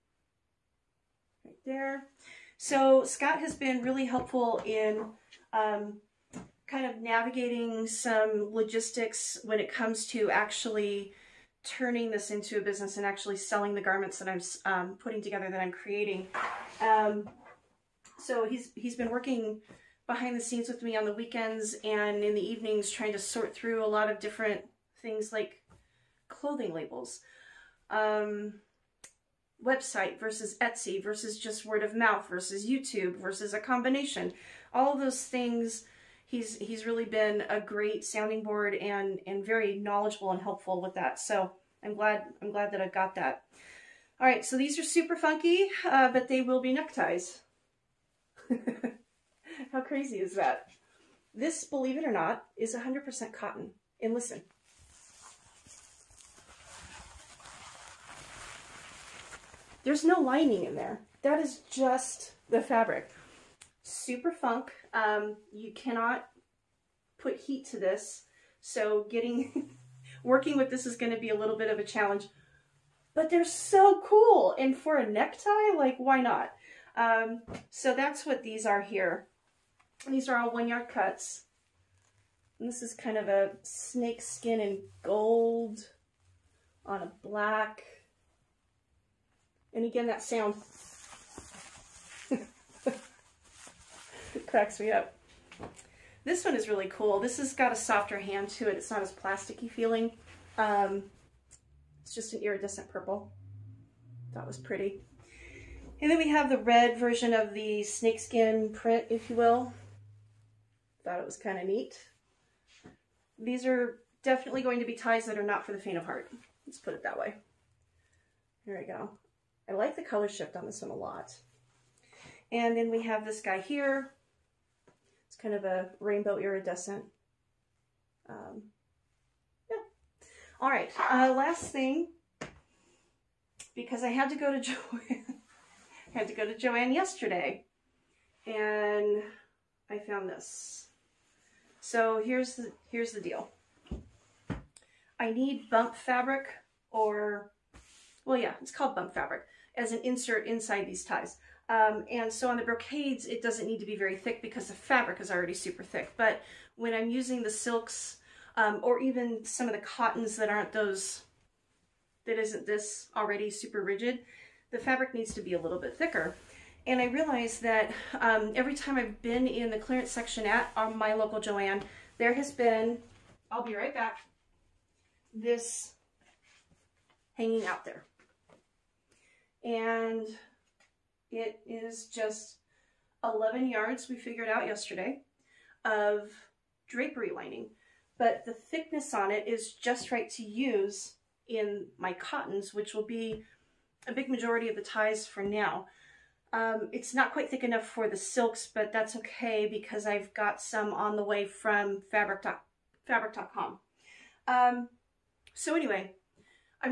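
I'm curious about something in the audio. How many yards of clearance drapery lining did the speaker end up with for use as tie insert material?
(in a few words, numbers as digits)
11.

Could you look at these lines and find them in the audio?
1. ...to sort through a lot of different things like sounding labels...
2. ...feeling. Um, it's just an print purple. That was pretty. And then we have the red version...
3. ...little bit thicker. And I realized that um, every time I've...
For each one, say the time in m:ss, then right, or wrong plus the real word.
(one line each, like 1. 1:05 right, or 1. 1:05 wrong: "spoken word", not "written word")
1. 0:23 wrong: "clothing", not "sounding"
2. 1:39 wrong: "iridescent", not "print"
3. 2:45 right.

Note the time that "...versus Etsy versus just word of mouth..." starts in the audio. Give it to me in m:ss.
0:30.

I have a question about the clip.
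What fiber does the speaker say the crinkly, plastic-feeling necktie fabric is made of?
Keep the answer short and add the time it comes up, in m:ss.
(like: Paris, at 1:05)
100% cotton, at 0:52.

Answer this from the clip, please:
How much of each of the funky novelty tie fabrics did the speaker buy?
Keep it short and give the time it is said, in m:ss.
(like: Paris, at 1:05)
one-yard cuts, at 1:20.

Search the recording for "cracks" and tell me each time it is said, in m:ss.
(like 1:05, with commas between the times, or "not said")
1:34.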